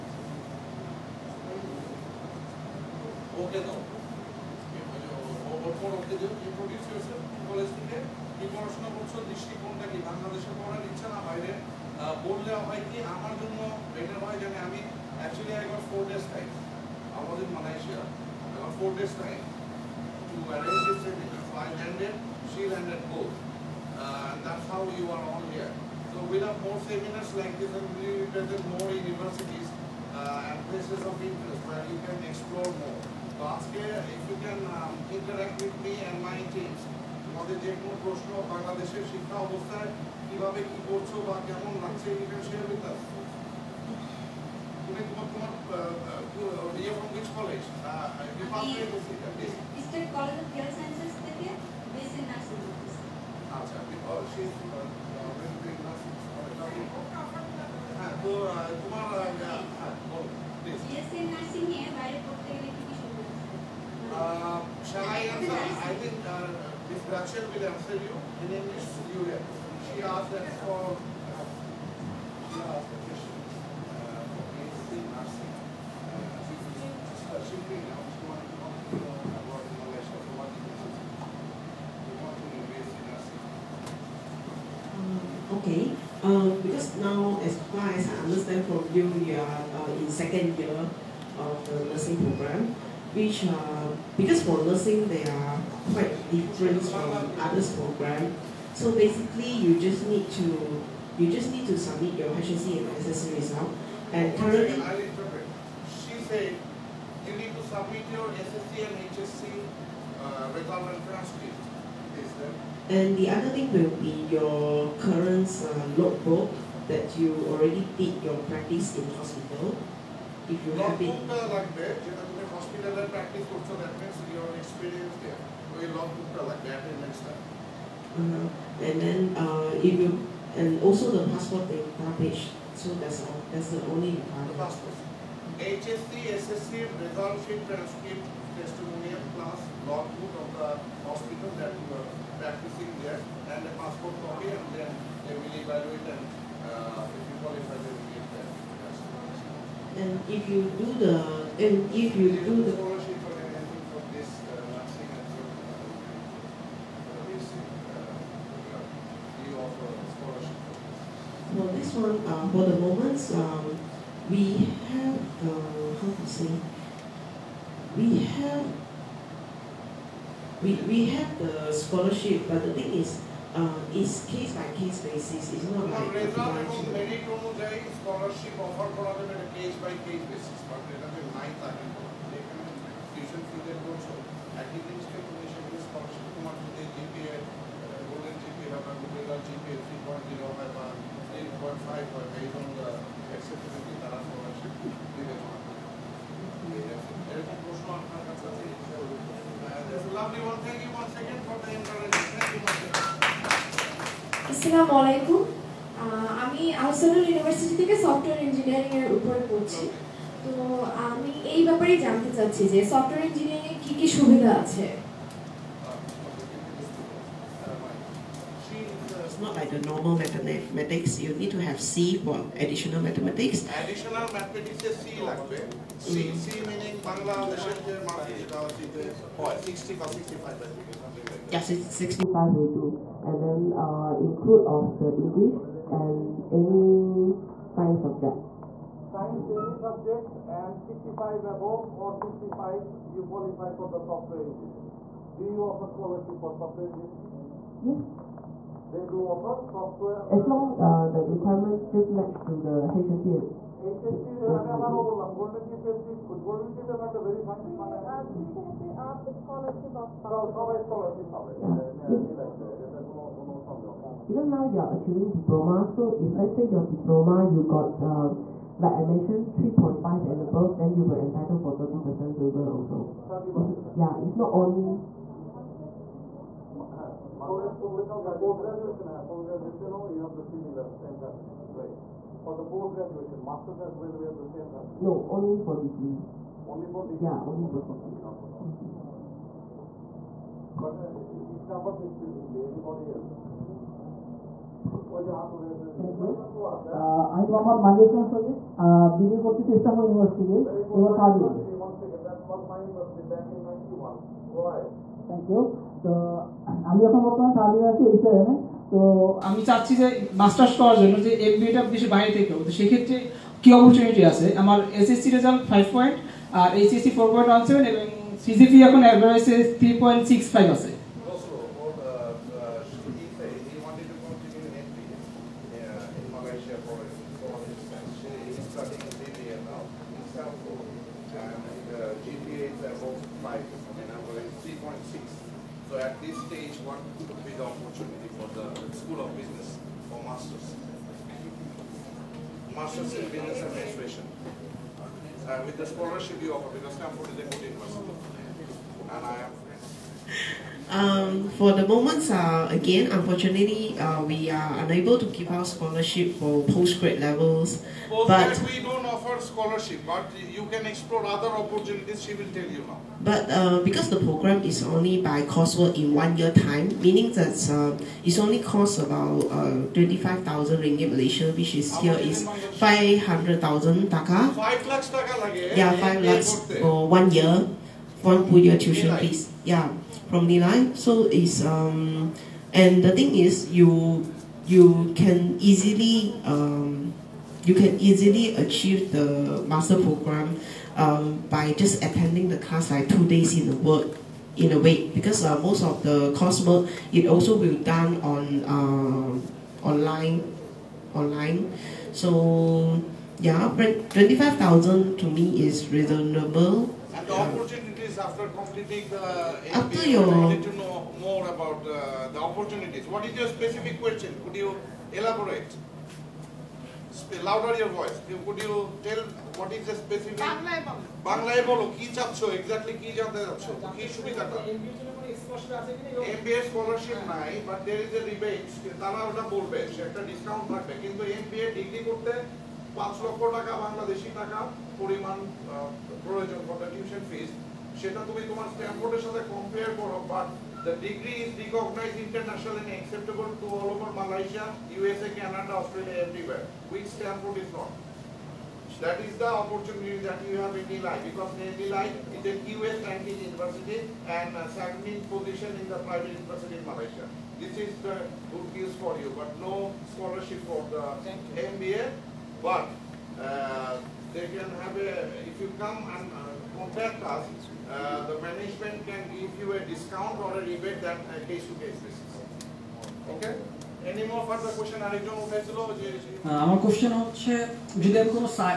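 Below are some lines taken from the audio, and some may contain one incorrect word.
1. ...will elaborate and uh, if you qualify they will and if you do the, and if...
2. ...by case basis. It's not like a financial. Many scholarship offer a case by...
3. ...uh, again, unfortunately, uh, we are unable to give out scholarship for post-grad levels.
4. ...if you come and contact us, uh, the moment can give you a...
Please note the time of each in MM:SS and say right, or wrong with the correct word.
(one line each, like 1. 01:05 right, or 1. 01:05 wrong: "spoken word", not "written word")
1. 02:25 wrong: "evaluate", not "elaborate"
2. 02:54 right
3. 05:52 right
4. 07:45 wrong: "management", not "moment".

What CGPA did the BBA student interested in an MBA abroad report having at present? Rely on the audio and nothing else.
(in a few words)
3.65.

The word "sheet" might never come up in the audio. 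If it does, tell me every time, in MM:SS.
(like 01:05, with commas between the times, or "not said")
02:17.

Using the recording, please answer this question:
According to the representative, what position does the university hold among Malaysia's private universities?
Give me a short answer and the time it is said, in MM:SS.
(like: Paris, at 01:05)
Second position, at 07:34.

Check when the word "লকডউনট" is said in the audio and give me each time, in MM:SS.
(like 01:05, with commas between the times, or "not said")
02:00, 02:05.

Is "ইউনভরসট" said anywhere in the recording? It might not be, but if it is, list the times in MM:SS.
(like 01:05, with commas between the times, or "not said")
03:27, 05:00.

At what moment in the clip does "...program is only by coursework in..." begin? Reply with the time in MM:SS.
06:04.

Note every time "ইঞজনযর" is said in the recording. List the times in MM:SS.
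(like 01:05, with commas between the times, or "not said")
03:28, 03:33.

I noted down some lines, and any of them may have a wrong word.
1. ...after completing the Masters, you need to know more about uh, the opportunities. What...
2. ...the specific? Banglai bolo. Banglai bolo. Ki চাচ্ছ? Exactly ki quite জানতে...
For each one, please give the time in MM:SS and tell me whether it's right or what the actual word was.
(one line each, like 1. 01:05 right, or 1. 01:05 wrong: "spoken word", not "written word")
1. 06:48 wrong: "MBA", not "Masters"
2. 06:59 wrong: "jante", not "quite".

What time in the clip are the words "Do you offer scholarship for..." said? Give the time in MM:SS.
04:05.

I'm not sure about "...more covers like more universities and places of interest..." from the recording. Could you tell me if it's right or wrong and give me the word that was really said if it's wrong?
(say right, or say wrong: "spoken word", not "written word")
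wrong: "seminars", not "covers".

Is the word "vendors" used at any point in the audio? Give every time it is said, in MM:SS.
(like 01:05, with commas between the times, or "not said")
not said.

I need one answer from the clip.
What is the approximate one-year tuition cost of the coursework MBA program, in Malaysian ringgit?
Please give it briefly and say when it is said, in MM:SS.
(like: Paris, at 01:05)
25,000 ringgit, at 06:09.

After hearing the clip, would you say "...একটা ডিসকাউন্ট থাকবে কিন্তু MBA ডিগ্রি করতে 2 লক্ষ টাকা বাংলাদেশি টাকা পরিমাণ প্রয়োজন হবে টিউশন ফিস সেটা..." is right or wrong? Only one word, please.
wrong.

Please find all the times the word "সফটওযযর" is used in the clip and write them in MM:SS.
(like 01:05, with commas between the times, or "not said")
03:28, 03:32.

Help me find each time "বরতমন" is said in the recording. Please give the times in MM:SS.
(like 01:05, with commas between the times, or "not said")
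05:07.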